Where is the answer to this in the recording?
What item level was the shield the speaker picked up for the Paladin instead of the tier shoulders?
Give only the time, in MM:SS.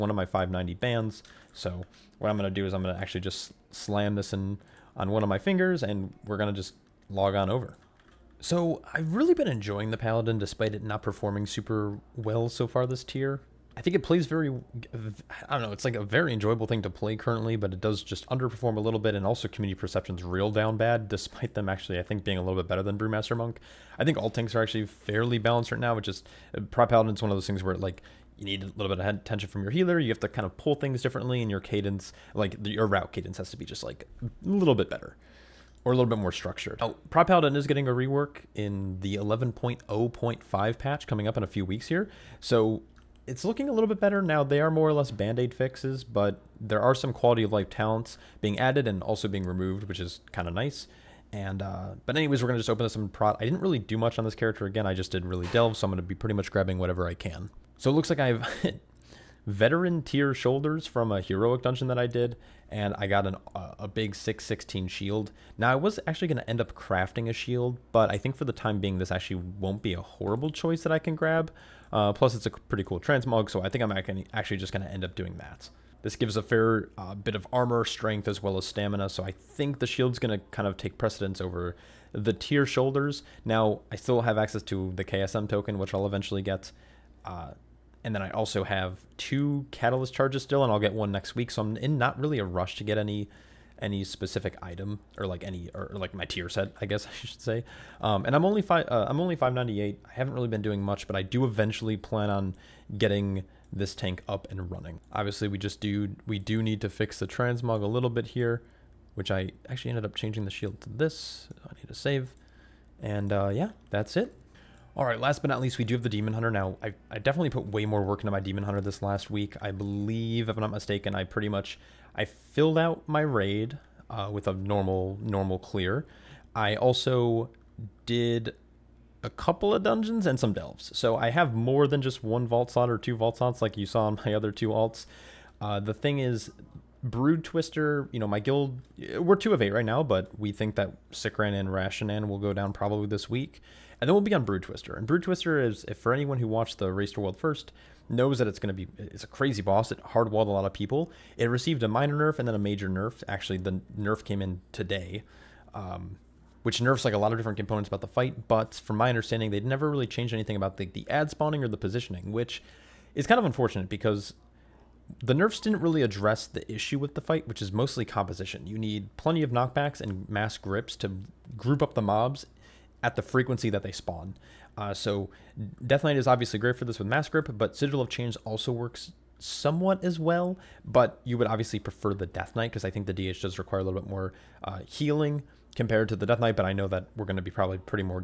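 01:04.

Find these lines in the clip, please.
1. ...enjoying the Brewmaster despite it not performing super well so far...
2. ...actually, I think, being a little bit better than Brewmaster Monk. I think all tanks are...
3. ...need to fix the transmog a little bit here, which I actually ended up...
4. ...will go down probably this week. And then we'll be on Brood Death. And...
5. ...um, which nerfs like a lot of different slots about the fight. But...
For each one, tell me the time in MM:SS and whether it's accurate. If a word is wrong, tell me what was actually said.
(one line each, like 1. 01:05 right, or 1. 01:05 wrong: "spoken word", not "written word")
1. 00:09 wrong: "Paladin", not "Brewmaster"
2. 00:21 right
3. 01:46 right
4. 02:22 wrong: "Twister", not "Death"
5. 02:35 wrong: "components", not "slots".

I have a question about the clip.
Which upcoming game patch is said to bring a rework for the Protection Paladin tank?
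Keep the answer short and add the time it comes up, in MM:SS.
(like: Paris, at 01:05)
11.0.5, at 00:39.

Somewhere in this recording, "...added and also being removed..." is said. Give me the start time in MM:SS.
00:48.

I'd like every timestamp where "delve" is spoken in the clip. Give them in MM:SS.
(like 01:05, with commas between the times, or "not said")
00:55, 02:10.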